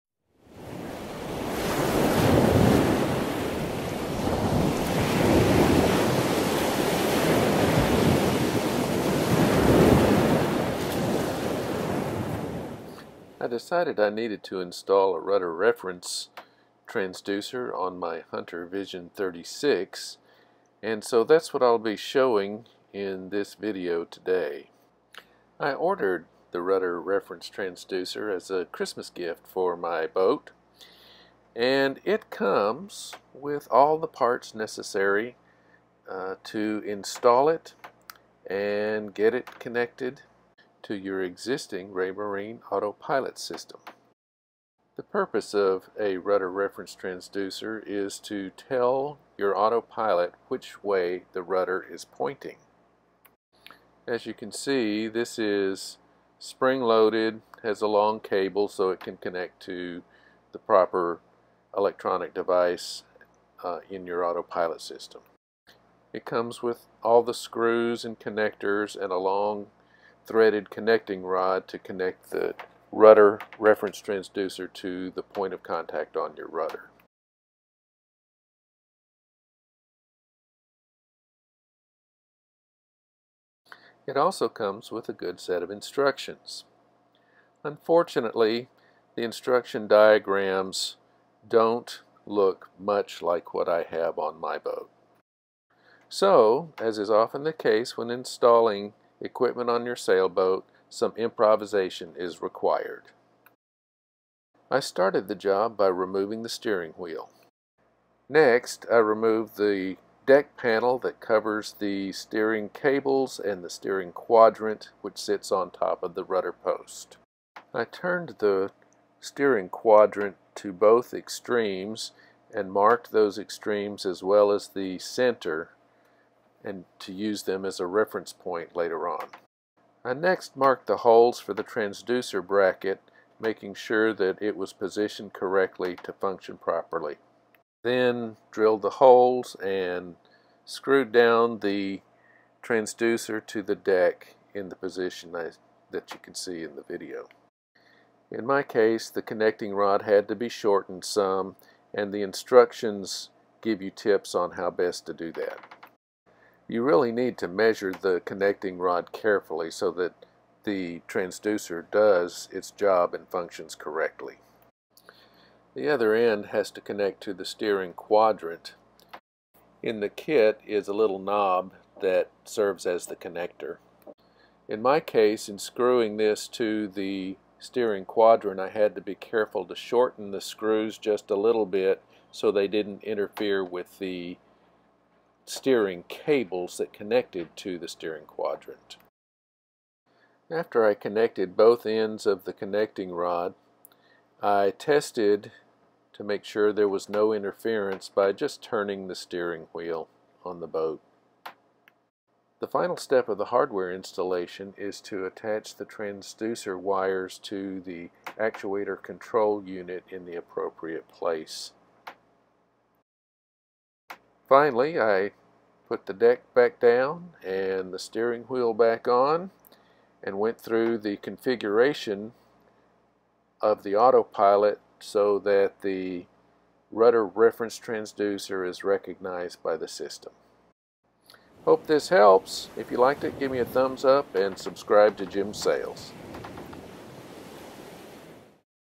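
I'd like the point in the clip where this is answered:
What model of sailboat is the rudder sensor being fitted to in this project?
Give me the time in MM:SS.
00:18.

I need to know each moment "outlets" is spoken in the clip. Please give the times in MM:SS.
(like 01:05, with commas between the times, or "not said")
not said.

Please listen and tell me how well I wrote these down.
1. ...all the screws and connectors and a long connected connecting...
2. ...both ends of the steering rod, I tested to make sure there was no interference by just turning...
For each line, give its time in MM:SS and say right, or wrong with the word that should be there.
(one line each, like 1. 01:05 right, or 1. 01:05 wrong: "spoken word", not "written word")
1. 01:07 wrong: "threaded", not "connected"
2. 03:11 wrong: "connecting", not "steering".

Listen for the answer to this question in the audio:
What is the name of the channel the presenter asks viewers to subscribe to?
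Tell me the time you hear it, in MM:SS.
03:55.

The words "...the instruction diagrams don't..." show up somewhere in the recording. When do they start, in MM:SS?
01:29.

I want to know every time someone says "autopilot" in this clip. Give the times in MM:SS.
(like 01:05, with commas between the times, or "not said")
00:42, 00:49, 01:04, 03:43.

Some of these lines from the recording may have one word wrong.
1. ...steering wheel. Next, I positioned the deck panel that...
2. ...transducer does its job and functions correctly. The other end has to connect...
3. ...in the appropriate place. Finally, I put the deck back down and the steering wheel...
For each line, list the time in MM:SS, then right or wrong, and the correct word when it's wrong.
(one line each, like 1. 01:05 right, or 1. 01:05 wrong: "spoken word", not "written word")
1. 01:46 wrong: "removed", not "positioned"
2. 02:41 right
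3. 03:30 right.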